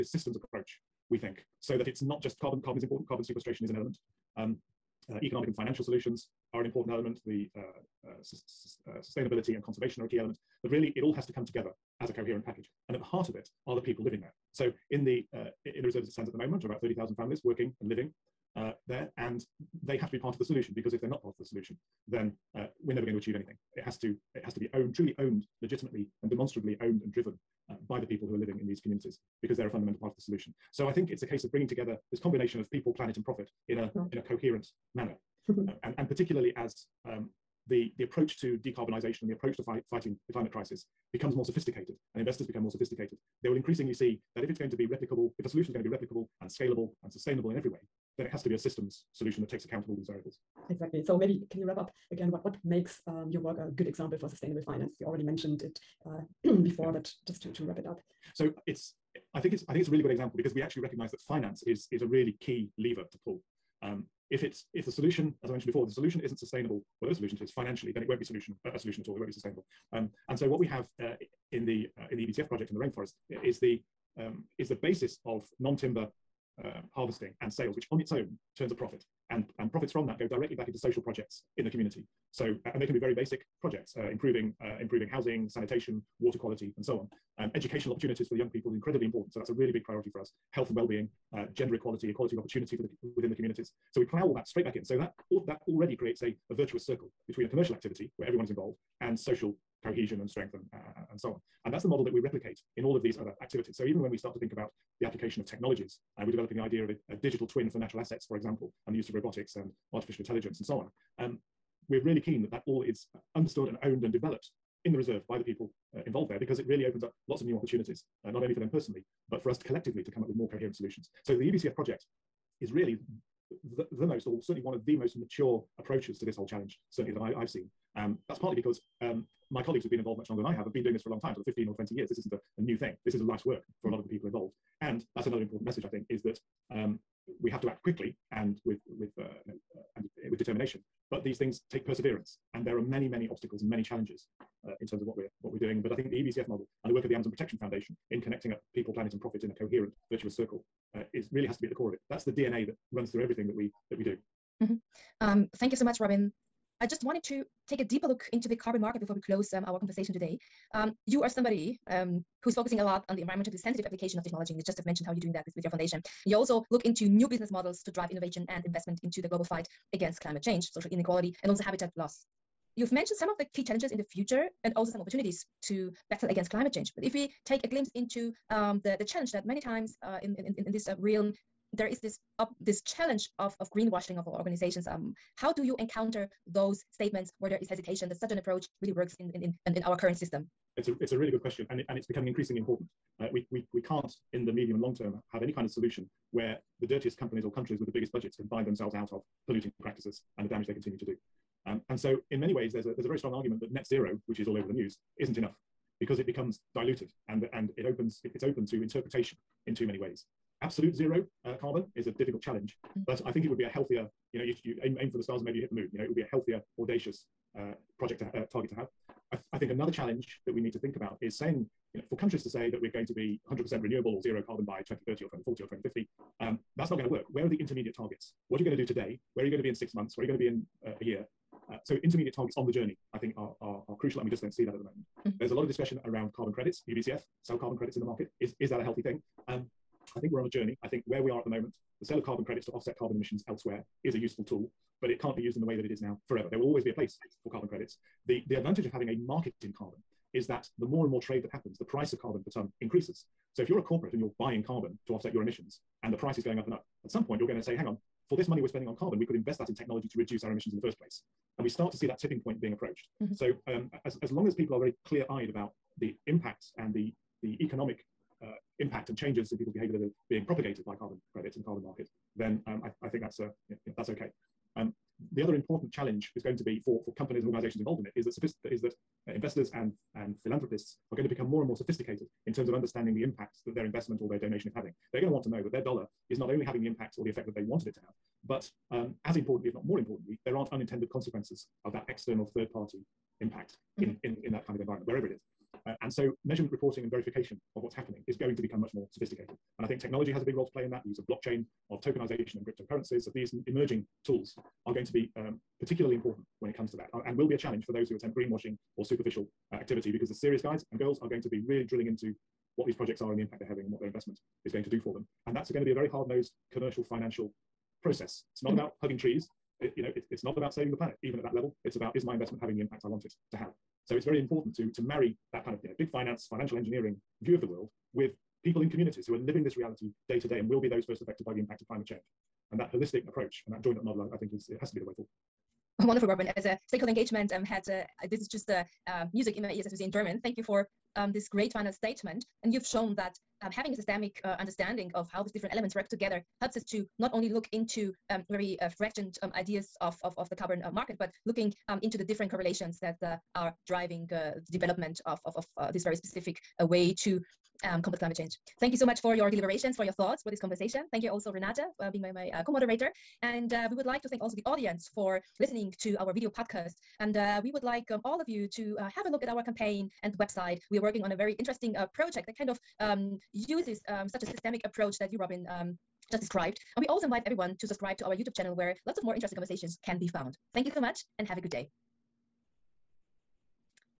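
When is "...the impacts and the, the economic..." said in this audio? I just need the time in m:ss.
4:26.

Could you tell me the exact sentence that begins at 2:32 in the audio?
That's the DNA that runs through everything that we that we do.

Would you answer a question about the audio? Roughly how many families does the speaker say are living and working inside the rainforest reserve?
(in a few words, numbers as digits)
30,000.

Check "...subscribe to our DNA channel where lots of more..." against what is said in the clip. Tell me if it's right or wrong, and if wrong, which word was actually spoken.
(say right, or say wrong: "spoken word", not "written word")
wrong: "YouTube", not "DNA".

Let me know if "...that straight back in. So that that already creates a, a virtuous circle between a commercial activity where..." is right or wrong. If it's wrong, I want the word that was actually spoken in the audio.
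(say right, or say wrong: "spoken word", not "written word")
right.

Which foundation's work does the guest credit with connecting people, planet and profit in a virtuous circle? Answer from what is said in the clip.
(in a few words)
Amazon Protection Foundation.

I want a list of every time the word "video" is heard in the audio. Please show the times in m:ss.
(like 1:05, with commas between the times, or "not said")
6:06.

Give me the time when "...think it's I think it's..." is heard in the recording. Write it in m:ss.
0:59.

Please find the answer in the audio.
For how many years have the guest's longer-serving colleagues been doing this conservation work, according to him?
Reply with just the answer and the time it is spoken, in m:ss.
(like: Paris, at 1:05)
15 or 20 years, at 2:11.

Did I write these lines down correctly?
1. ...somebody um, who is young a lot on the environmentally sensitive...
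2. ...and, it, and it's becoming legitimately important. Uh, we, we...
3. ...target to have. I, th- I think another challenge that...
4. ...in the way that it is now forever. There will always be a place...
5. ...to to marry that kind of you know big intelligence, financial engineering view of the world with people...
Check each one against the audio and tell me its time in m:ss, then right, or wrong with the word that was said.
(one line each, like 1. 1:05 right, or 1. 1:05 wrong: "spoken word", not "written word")
1. 2:41 wrong: "focusing", not "young"
2. 3:11 wrong: "increasingly", not "legitimately"
3. 3:38 right
4. 4:05 right
5. 5:24 wrong: "finance", not "intelligence".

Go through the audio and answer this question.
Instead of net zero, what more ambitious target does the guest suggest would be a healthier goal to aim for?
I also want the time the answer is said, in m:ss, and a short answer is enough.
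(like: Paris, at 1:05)
Absolute zero, at 3:30.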